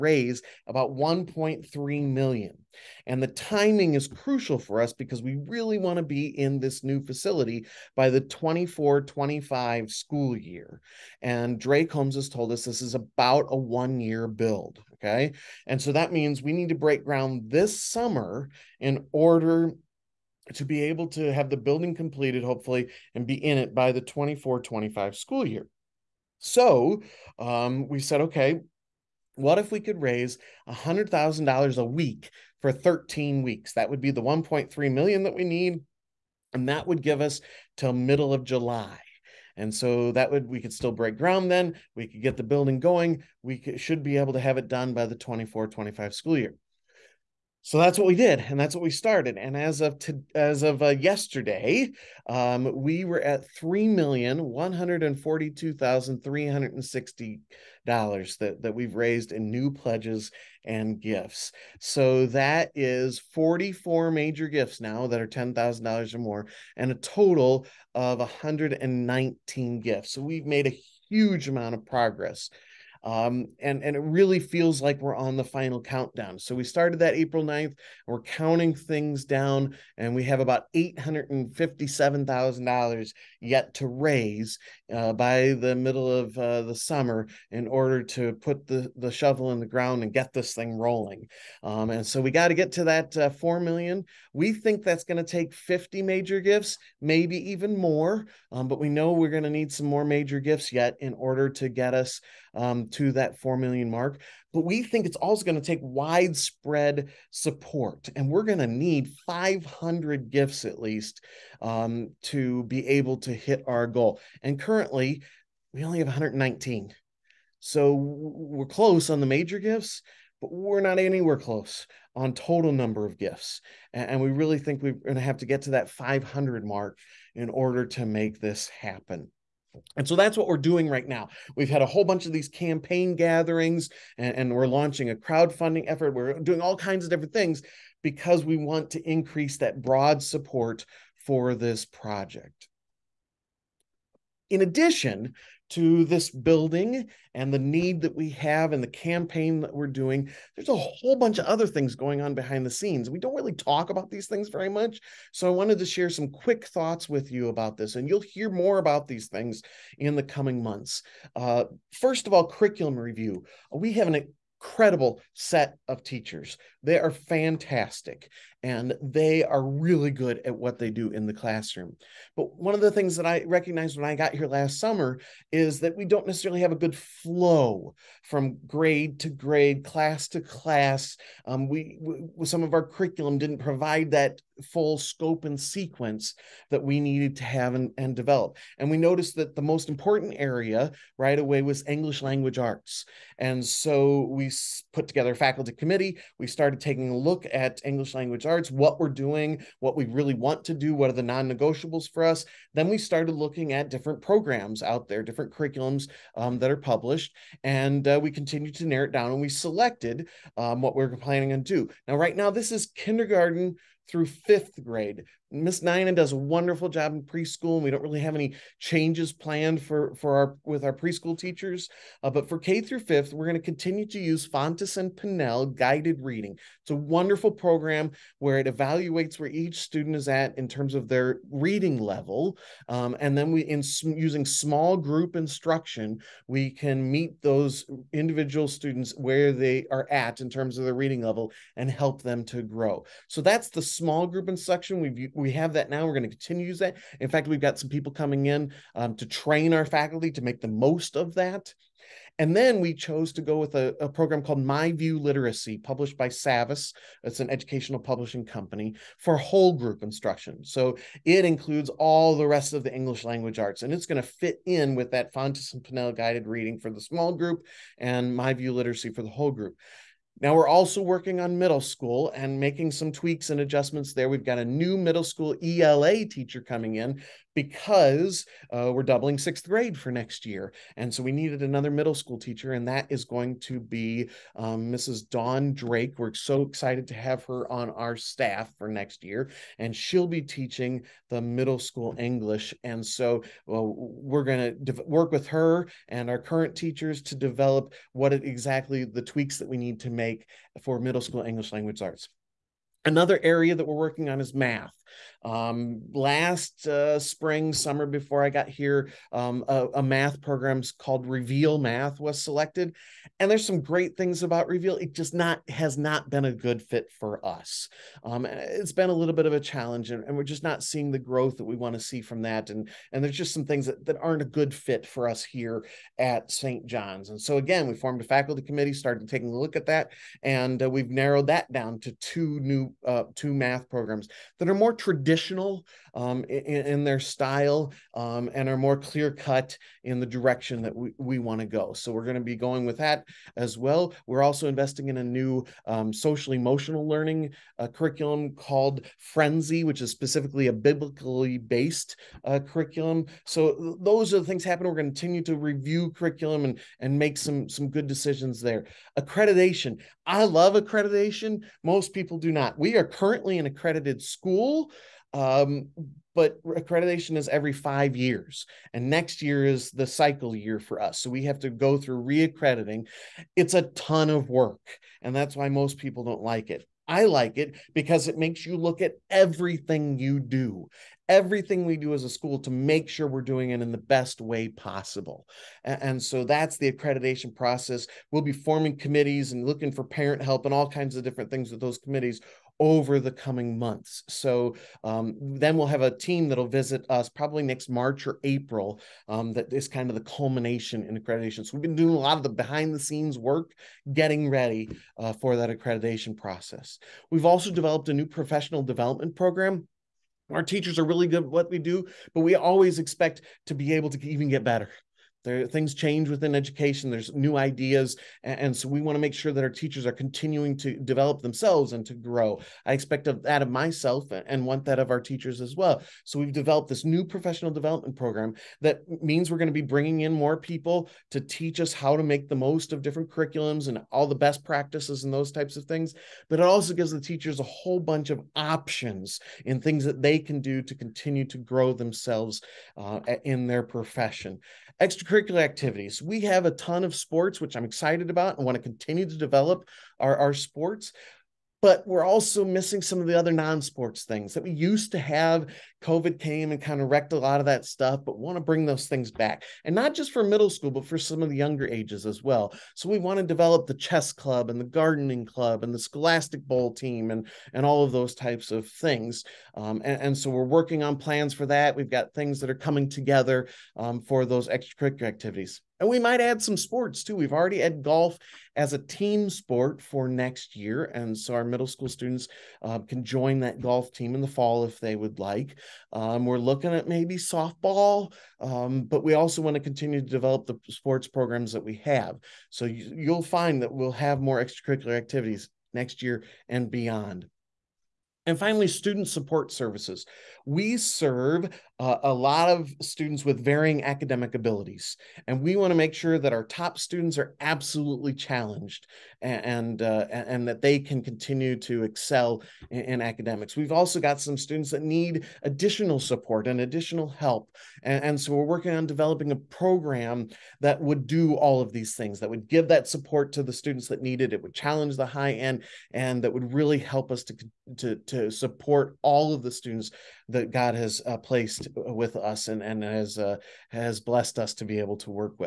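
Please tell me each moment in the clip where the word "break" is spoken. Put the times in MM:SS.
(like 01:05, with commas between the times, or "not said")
00:16, 00:40.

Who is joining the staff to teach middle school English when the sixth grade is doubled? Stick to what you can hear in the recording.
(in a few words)
Dawn Drake.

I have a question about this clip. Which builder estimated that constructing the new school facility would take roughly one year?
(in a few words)
Drake Homes.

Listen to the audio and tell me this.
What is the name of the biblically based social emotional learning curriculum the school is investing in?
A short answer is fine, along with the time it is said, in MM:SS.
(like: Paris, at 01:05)
Friendzy, at 05:49.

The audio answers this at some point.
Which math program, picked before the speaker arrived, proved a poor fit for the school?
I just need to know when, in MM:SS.
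05:11.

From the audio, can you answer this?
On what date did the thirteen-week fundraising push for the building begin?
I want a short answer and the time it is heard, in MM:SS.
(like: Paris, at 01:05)
April 9th, at 01:17.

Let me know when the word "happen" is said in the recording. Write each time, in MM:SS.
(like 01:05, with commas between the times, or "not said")
02:08, 05:54.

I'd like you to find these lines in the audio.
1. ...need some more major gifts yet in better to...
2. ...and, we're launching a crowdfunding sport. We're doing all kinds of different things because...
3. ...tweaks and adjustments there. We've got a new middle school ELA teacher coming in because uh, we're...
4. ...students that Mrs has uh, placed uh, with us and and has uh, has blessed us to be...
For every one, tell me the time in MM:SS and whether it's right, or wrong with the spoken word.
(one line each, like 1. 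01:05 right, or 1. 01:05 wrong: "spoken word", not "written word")
1. 01:39 wrong: "order", not "better"
2. 02:14 wrong: "effort", not "sport"
3. 04:33 right
4. 08:49 wrong: "God", not "Mrs".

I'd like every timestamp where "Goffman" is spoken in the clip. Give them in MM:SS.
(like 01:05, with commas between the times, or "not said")
not said.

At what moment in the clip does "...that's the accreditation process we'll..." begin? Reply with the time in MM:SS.
06:26.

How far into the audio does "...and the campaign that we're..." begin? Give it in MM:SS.
02:28.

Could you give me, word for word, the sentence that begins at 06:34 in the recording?
So um, then we'll have a team that'll visit us probably next March or April.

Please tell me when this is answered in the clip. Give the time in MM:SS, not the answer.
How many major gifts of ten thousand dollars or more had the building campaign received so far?
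01:03.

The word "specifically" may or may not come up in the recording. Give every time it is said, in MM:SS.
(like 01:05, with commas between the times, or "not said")
05:50.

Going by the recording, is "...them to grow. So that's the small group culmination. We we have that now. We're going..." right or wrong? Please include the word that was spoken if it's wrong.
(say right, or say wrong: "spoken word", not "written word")
wrong: "instruction", not "culmination".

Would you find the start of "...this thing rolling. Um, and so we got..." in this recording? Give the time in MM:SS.
01:30.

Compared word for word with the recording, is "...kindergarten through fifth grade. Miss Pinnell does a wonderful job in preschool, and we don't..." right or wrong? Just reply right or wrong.
wrong.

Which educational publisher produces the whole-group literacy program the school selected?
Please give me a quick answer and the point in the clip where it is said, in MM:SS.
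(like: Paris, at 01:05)
Savvas, at 04:16.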